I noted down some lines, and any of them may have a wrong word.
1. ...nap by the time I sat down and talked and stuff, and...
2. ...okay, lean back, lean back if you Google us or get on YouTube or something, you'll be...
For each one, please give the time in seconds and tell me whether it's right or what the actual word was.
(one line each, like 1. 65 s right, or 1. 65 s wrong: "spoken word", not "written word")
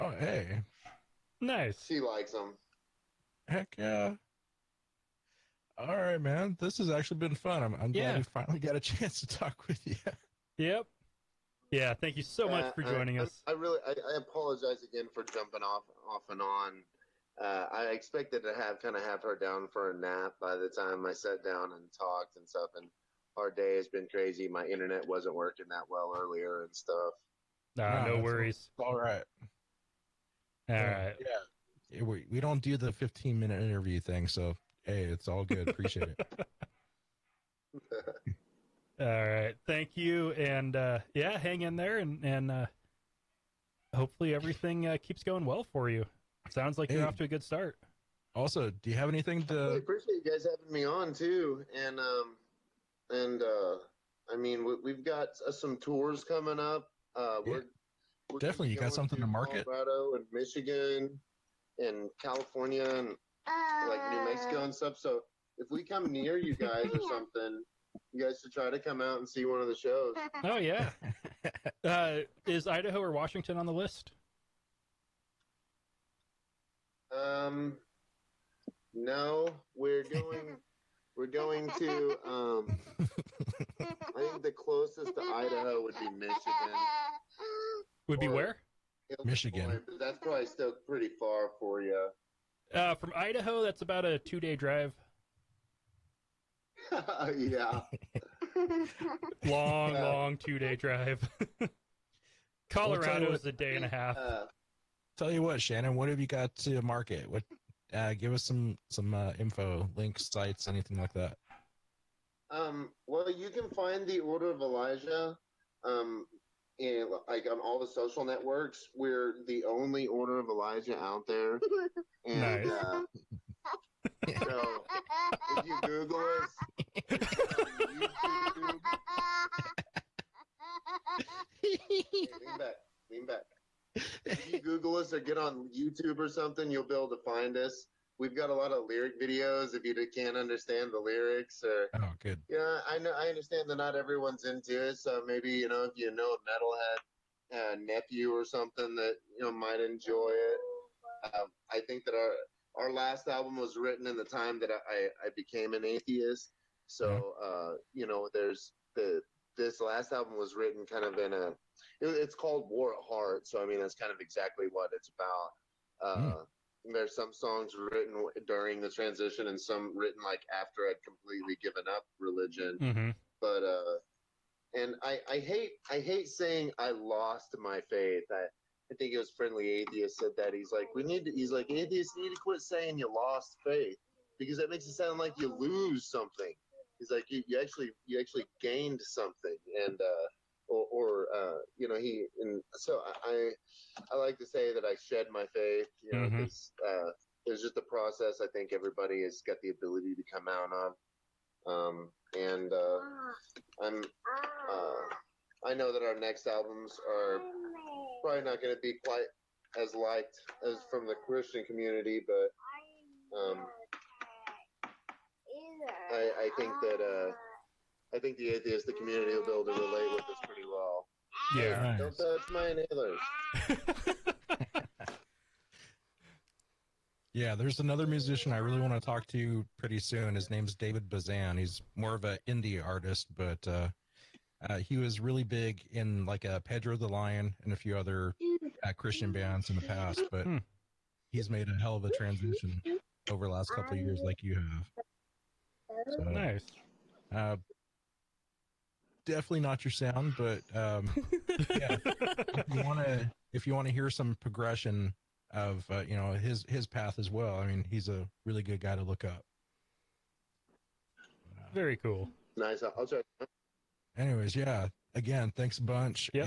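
1. 19 s right
2. 132 s right.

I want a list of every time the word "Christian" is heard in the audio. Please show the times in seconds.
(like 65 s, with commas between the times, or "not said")
211 s, 238 s.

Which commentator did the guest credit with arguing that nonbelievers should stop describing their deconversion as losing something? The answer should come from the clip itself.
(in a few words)
Friendly Atheist.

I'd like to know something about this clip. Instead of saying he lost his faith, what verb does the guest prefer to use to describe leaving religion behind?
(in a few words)
Shed.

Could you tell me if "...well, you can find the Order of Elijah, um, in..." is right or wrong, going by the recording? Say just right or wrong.
right.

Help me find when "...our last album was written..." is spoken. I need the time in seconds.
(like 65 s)
152 s.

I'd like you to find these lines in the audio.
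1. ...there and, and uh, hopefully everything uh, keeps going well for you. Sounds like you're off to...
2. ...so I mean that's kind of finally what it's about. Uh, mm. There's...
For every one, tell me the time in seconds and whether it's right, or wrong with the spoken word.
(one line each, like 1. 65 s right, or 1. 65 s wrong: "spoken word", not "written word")
1. 41 s right
2. 163 s wrong: "exactly", not "finally".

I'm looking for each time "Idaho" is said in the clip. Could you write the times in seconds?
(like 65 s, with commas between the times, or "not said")
72 s, 85 s, 93 s.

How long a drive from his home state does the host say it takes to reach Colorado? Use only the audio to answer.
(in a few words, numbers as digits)
A day and a half.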